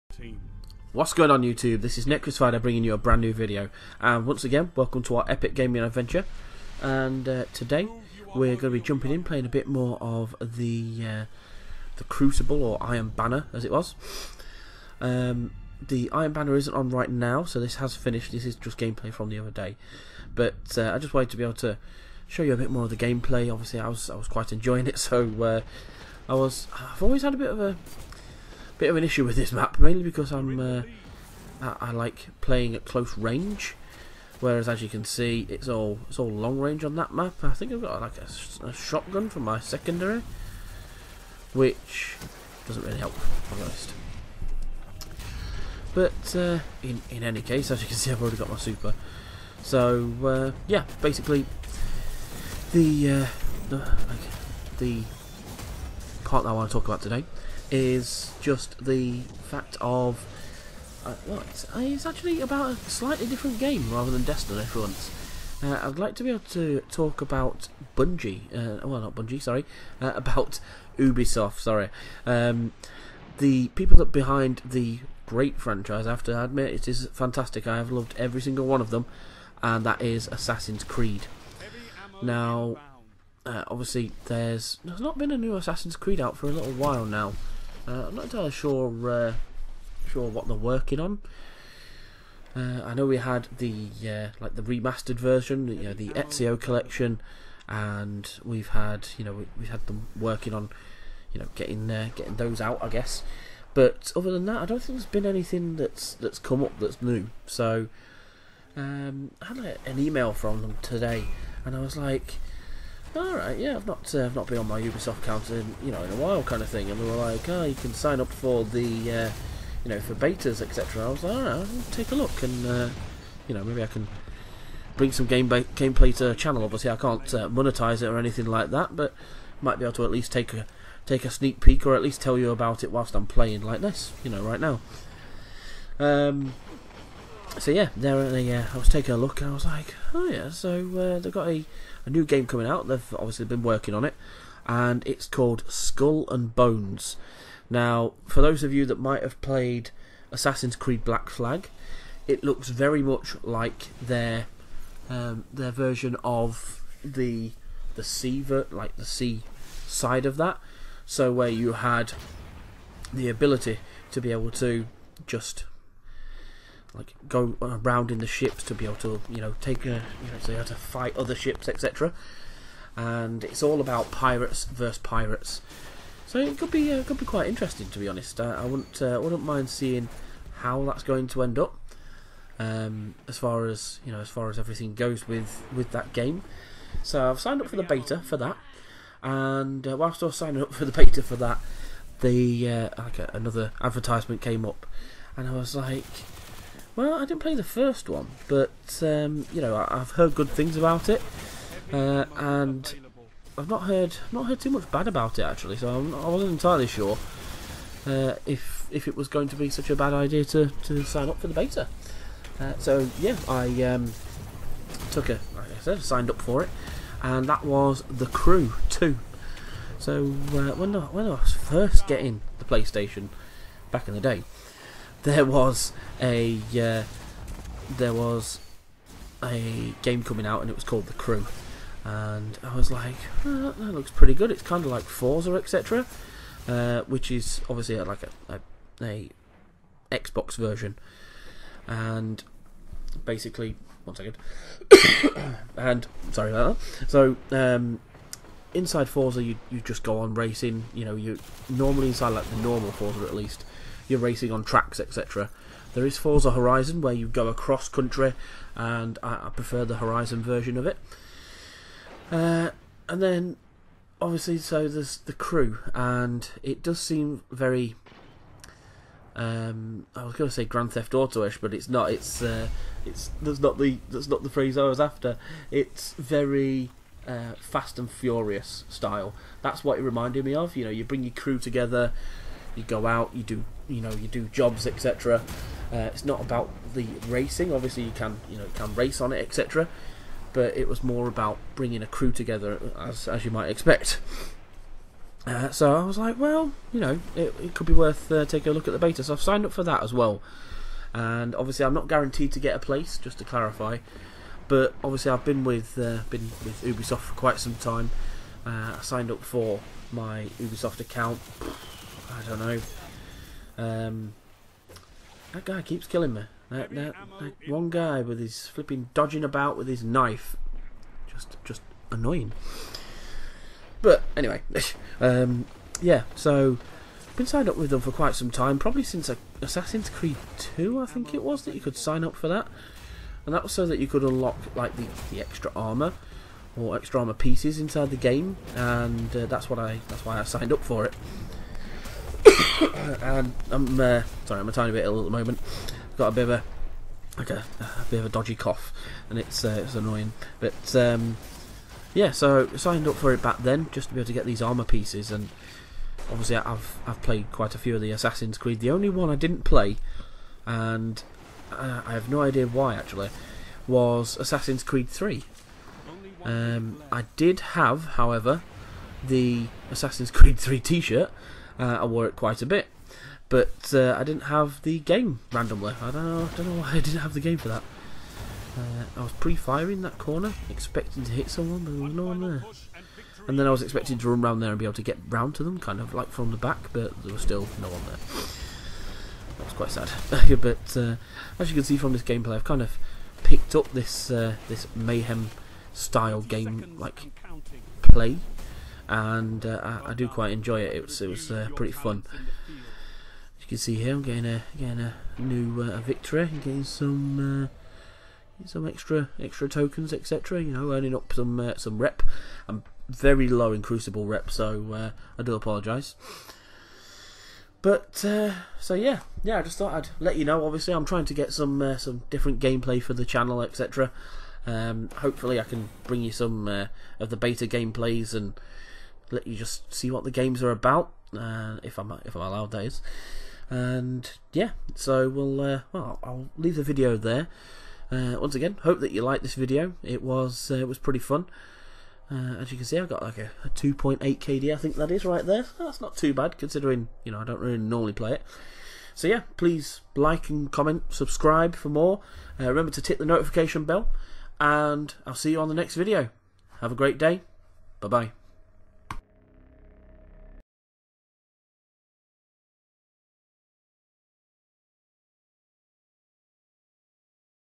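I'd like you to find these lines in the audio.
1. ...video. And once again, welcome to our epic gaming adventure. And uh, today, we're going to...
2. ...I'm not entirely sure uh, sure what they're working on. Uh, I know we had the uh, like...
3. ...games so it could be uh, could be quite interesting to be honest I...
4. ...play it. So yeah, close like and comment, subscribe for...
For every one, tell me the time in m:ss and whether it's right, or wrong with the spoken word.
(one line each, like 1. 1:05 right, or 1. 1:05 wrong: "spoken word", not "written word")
1. 0:03 right
2. 1:28 right
3. 2:54 wrong: "pirates", not "games"
4. 7:28 wrong: "please", not "close".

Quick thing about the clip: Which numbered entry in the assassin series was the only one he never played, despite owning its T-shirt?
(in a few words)
Assassin's Creed 3.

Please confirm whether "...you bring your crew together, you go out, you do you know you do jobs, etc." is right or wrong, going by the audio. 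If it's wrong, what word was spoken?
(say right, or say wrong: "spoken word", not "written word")
right.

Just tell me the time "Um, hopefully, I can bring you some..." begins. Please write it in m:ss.
7:04.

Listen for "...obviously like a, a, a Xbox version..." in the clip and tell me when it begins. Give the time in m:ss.
3:57.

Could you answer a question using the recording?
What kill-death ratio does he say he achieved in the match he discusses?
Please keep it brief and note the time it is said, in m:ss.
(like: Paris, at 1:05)
2.8, at 7:23.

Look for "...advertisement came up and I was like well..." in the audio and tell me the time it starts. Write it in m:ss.
3:13.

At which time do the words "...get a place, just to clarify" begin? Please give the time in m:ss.
5:02.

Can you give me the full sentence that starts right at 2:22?
They've obviously been working on it, and it's called Skull and Bones.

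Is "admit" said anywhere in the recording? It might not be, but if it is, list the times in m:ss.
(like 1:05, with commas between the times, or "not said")
1:16.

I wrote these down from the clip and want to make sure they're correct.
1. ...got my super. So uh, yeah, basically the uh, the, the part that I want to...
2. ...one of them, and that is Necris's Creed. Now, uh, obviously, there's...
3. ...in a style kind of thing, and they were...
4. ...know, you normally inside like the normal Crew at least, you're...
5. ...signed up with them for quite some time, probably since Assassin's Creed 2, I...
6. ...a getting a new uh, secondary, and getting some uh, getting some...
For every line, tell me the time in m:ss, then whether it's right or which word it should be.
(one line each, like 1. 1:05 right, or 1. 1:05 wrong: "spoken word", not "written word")
1. 0:48 right
2. 1:18 wrong: "Assassin", not "Necris"
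3. 1:56 wrong: "while", not "style"
4. 4:11 wrong: "Forza", not "Crew"
5. 5:27 right
6. 6:44 wrong: "victory", not "secondary".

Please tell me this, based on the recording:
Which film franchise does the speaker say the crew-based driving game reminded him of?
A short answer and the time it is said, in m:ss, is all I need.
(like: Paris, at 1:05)
Fast and Furious, at 4:37.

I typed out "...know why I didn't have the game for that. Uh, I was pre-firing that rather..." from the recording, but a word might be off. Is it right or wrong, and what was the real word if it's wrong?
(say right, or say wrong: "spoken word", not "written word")
wrong: "corner", not "rather".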